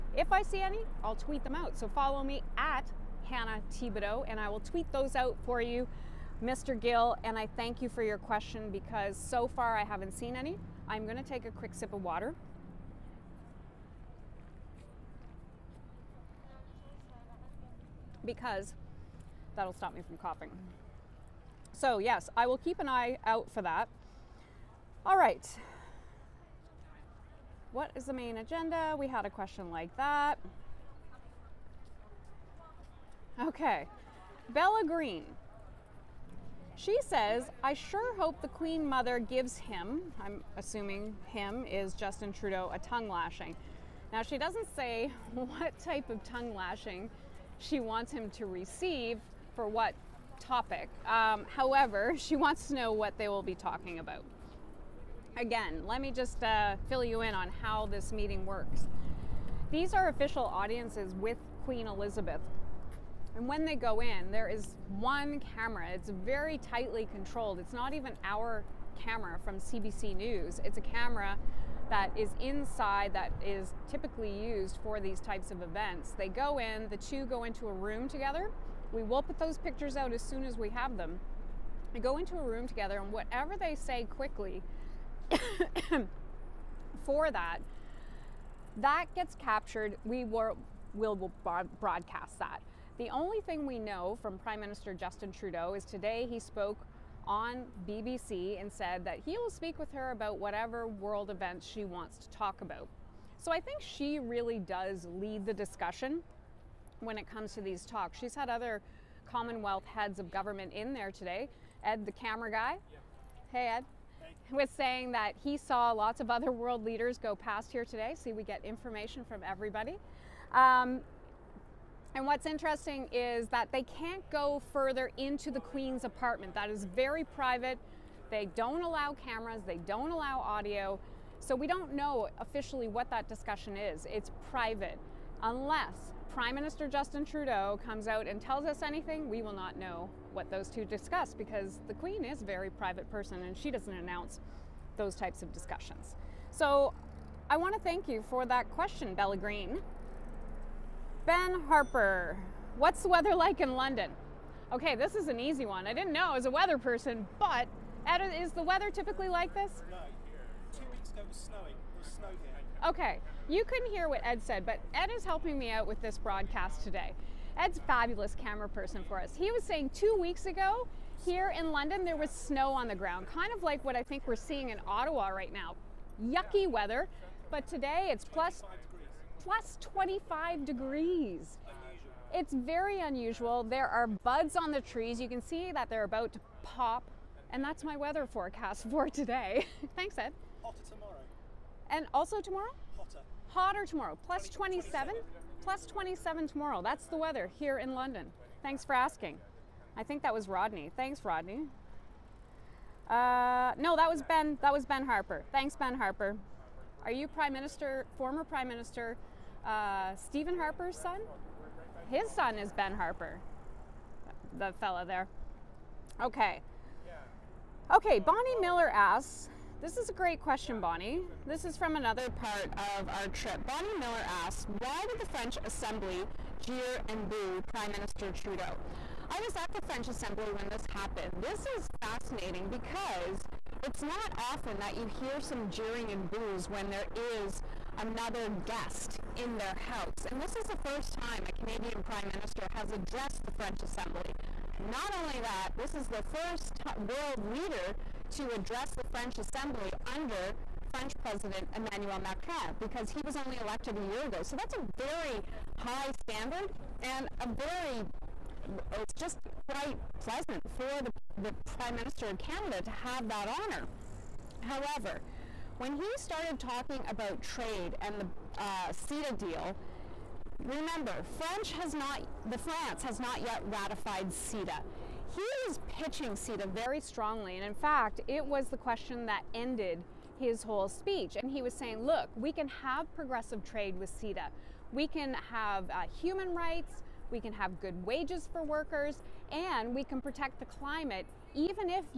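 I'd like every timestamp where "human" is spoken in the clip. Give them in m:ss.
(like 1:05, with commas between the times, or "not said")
4:46.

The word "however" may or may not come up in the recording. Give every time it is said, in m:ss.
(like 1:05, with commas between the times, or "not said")
0:51, 4:24.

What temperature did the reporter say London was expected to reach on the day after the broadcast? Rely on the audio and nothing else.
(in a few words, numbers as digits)
Plus 27.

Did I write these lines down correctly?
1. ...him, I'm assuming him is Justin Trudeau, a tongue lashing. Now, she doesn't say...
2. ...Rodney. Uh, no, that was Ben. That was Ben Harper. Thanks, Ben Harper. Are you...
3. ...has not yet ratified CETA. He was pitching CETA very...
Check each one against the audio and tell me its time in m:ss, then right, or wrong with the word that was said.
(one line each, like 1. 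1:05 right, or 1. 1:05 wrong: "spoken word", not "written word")
1. 0:39 right
2. 3:21 right
3. 4:33 right.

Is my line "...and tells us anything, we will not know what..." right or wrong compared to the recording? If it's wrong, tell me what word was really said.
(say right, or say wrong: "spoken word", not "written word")
right.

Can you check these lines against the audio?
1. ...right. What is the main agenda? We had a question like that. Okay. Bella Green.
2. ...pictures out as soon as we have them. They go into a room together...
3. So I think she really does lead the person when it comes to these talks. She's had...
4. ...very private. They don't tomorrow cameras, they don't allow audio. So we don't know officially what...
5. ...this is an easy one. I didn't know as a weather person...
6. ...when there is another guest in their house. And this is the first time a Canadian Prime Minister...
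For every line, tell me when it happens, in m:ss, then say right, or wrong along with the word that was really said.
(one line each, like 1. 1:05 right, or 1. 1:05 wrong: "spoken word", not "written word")
1. 0:25 right
2. 1:19 right
3. 1:43 wrong: "discussion", not "person"
4. 2:06 wrong: "allow", not "tomorrow"
5. 2:34 right
6. 3:56 right.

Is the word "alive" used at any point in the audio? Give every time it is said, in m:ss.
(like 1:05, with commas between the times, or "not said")
not said.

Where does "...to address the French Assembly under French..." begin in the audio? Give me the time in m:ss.
4:08.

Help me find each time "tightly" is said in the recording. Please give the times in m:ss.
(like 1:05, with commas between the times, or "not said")
1:06.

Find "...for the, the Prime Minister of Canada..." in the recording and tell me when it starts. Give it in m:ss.
4:20.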